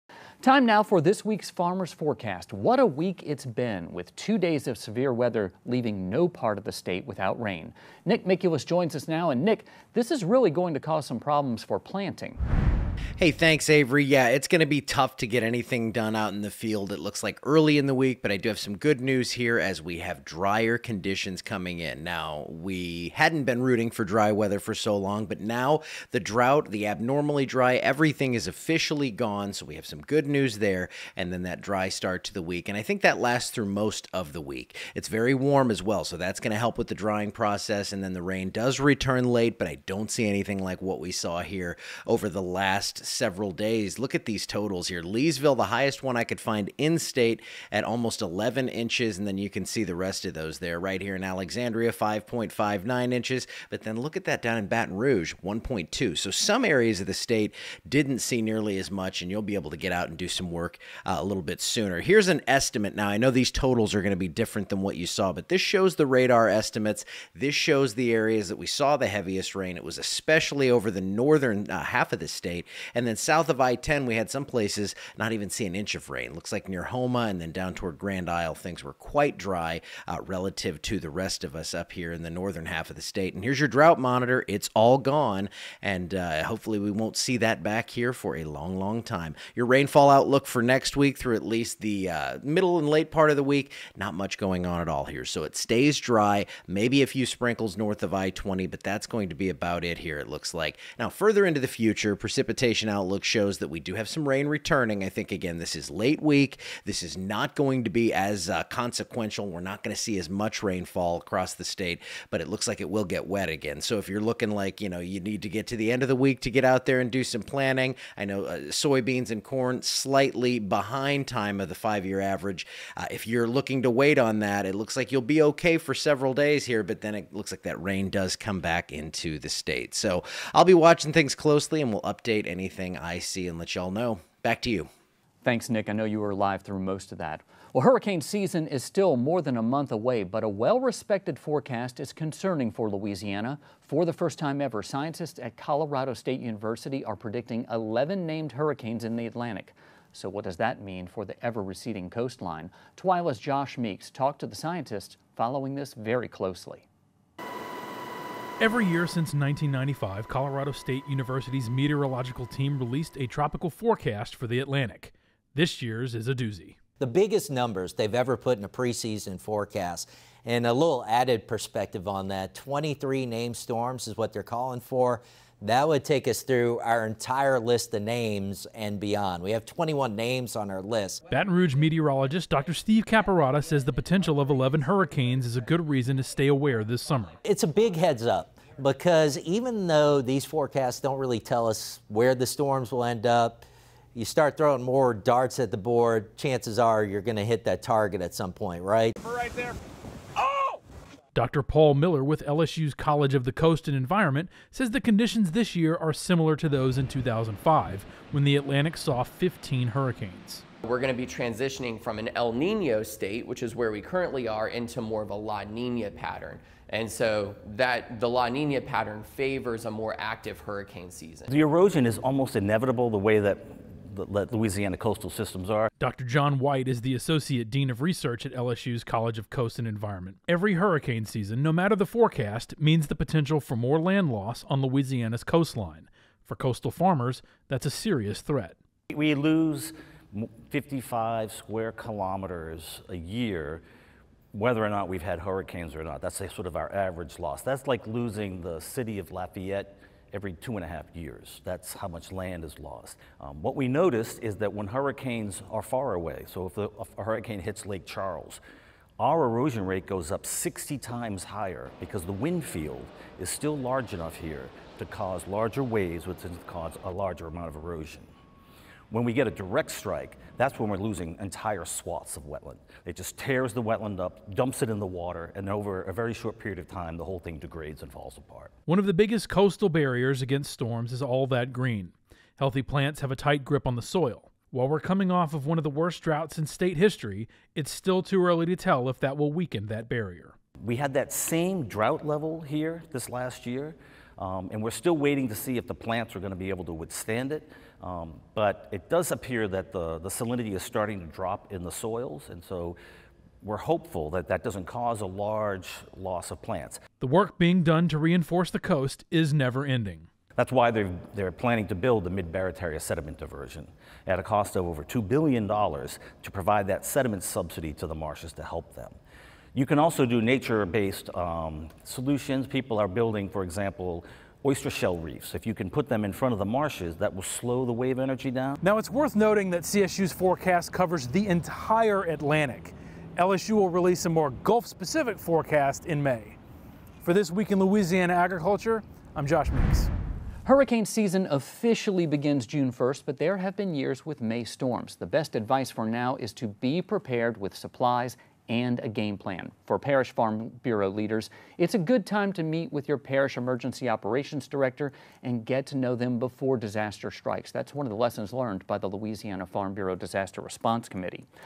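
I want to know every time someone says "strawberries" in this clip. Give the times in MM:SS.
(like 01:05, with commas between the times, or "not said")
not said.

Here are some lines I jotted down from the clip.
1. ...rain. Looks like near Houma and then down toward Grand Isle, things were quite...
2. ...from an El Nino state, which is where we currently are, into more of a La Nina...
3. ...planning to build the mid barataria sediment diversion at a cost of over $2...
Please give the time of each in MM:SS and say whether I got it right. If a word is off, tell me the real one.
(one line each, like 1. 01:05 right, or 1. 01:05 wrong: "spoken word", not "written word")
1. 01:16 right
2. 03:32 right
3. 05:11 right.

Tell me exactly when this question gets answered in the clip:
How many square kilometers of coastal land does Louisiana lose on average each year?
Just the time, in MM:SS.
04:00.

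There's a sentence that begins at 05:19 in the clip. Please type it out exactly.
You can also do nature-based um, solutions.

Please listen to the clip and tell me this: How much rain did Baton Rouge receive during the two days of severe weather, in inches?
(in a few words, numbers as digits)
1.2.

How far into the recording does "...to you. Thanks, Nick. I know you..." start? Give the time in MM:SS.
02:14.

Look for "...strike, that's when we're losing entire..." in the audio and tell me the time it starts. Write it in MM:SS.
04:29.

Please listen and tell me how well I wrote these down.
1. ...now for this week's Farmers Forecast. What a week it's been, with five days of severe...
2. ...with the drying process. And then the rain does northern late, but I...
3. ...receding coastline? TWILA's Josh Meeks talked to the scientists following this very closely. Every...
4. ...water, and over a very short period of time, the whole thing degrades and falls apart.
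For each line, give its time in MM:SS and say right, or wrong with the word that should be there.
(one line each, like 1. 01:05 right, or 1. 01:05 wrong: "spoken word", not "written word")
1. 00:00 wrong: "two", not "five"
2. 00:36 wrong: "return", not "northern"
3. 02:31 right
4. 04:35 right.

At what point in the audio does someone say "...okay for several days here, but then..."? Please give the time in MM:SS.
02:05.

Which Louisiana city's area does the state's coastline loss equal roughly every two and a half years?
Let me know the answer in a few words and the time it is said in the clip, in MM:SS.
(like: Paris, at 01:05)
Lafayette, at 04:09.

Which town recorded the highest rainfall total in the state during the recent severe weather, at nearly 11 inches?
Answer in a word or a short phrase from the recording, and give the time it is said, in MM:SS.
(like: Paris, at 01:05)
Leesville, at 00:45.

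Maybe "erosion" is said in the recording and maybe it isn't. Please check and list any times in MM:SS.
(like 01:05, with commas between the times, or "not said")
03:41, 04:19, 04:27.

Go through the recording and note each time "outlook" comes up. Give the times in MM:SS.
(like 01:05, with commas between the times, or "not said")
01:30, 01:42.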